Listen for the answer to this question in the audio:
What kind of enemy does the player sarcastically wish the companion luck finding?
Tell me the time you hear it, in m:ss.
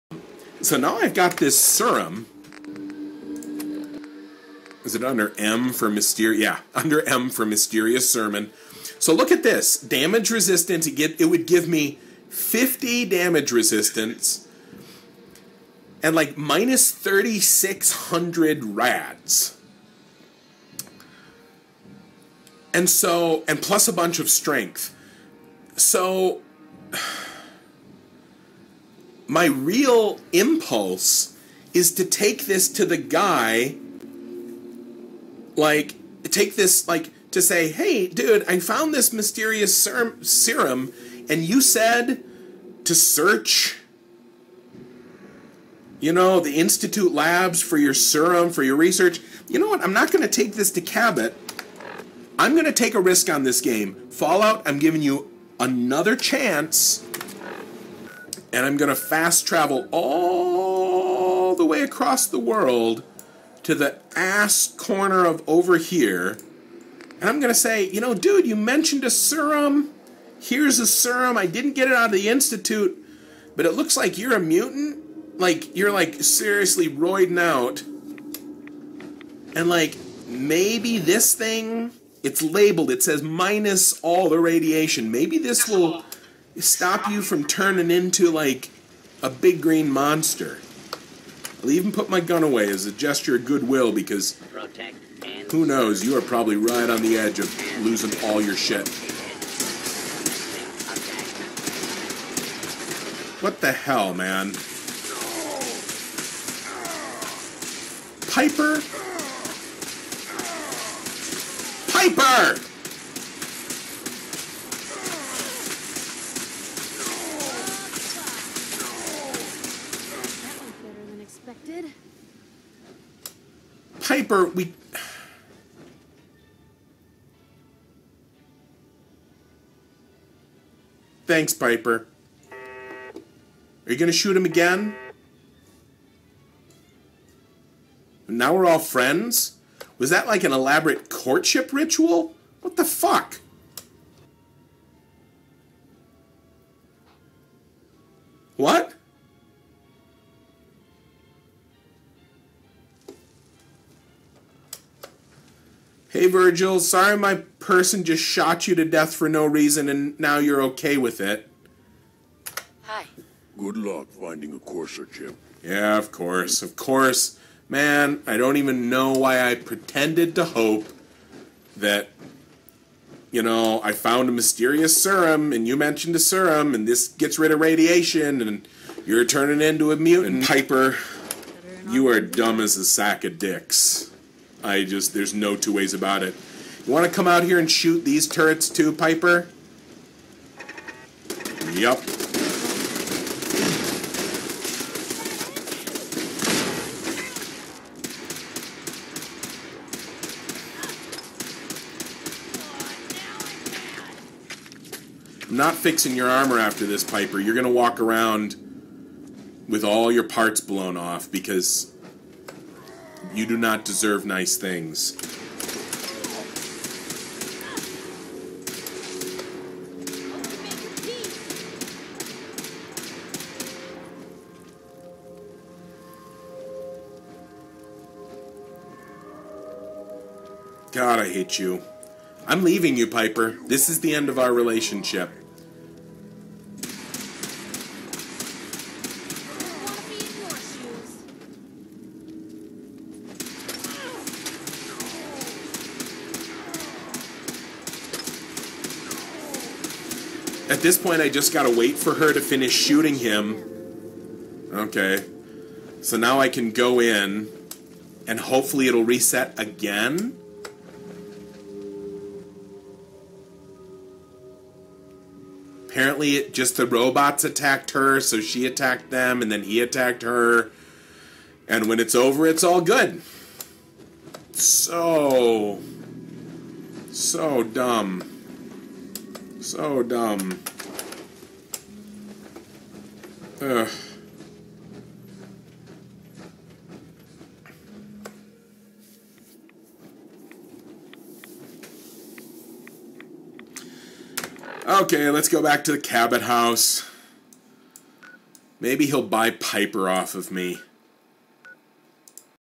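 2:44.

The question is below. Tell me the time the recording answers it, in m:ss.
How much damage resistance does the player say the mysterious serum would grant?
0:12.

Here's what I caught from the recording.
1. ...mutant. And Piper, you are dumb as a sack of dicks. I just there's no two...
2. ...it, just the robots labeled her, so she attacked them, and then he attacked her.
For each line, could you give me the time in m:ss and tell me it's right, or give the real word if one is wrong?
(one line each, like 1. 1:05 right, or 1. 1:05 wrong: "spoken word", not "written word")
1. 2:59 right
2. 4:26 wrong: "attacked", not "labeled".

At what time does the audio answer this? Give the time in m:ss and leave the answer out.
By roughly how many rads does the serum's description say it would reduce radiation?
0:16.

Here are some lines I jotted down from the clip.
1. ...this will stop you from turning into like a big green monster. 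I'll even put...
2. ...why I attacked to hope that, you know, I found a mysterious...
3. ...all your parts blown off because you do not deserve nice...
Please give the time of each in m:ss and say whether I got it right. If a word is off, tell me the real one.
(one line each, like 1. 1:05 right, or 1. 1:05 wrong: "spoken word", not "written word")
1. 1:25 right
2. 2:49 wrong: "pretended", not "attacked"
3. 3:29 right.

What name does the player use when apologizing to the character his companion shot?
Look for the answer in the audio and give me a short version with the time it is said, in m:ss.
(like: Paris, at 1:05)
Virgil, at 2:36.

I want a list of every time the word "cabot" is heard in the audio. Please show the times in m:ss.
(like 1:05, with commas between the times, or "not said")
0:50, 4:55.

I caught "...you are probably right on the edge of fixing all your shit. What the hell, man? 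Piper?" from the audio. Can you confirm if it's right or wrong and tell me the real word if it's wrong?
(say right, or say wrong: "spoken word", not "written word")
wrong: "losing", not "fixing".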